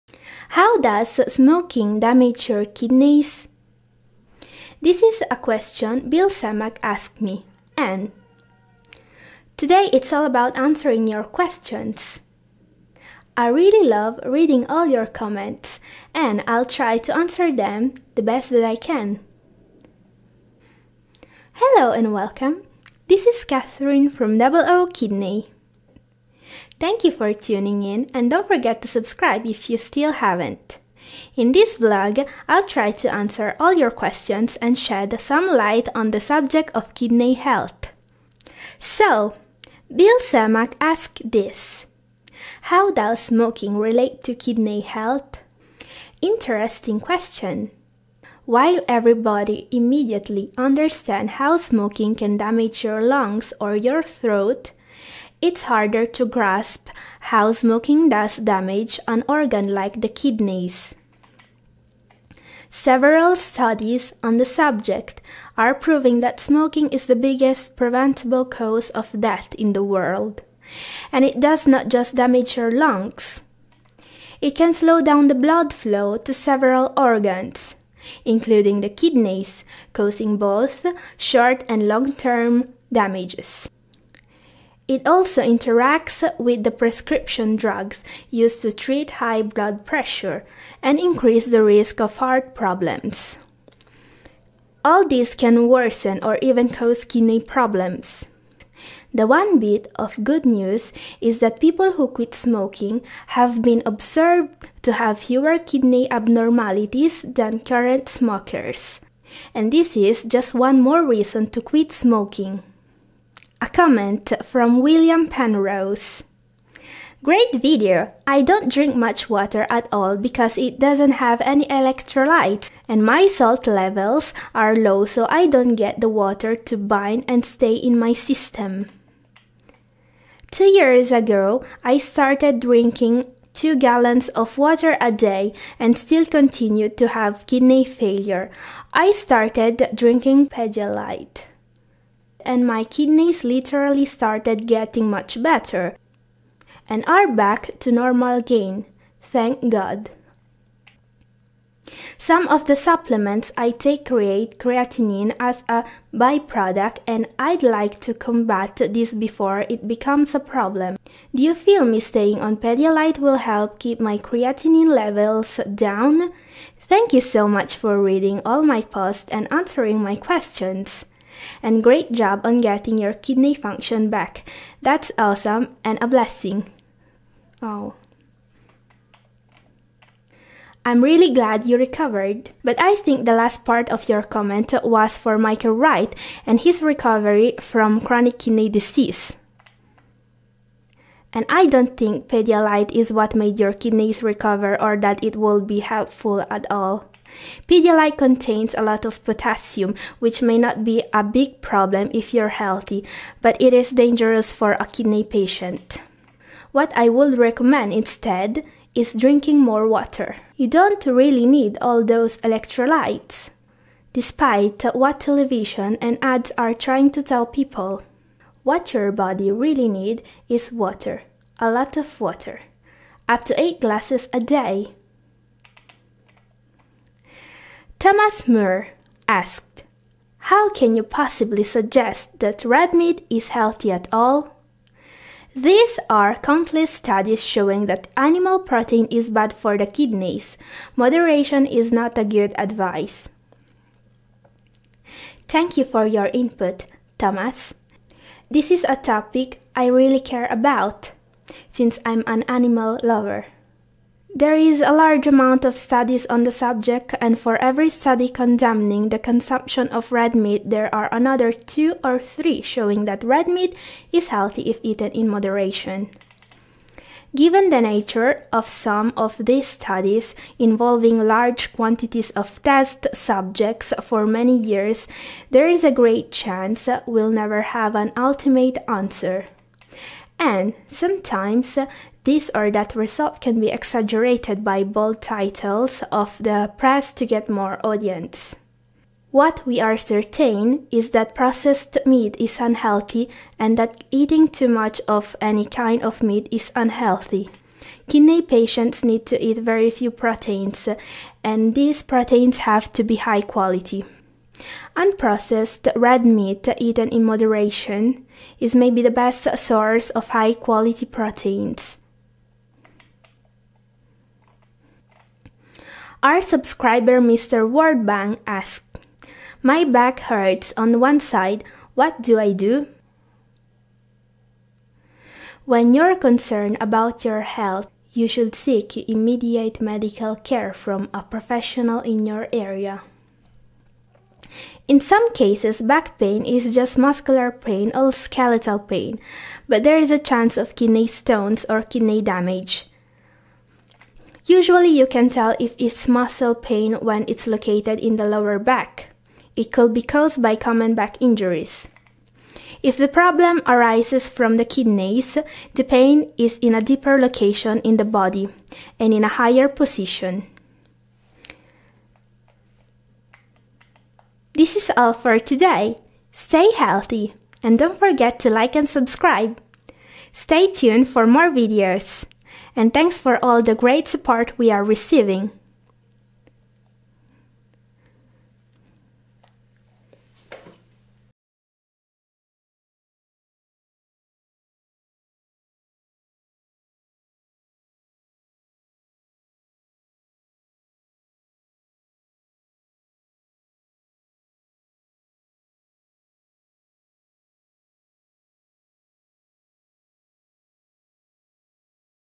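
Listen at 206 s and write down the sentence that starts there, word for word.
What I would recommend instead is drinking more water.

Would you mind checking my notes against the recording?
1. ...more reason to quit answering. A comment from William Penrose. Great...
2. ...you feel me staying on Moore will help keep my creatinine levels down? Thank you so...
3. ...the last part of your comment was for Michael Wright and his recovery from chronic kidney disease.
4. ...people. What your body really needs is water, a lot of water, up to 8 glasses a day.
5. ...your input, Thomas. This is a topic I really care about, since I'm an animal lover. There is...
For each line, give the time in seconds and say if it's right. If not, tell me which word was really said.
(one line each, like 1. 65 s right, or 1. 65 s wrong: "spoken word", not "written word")
1. 110 s wrong: "smoking", not "answering"
2. 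161 s wrong: "Pedialyte", not "Moore"
3. 183 s right
4. 217 s right
5. 246 s right.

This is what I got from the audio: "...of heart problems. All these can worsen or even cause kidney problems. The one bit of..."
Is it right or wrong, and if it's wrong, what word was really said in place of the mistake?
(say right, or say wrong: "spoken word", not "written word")
right.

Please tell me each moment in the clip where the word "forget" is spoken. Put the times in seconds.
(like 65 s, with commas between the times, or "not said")
28 s, 367 s.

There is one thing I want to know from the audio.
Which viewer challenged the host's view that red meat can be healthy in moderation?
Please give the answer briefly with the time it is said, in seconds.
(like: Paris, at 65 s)
Thomas Moore, at 228 s.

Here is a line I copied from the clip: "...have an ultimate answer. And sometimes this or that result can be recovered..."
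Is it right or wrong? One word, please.
wrong.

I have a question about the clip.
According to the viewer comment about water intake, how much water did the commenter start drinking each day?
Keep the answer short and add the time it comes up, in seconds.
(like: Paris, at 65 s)
2 gallons, at 133 s.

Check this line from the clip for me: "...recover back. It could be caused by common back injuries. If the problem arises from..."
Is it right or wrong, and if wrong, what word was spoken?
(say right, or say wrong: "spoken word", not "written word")
wrong: "lower", not "recover".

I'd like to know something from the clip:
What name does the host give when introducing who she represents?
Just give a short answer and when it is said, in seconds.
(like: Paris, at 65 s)
Double O Kidney, at 24 s.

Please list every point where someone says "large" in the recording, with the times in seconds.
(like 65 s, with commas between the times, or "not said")
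254 s, 271 s.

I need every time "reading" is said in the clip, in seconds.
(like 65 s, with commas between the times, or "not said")
14 s, 168 s.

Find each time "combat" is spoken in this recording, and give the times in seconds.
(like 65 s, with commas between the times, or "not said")
158 s.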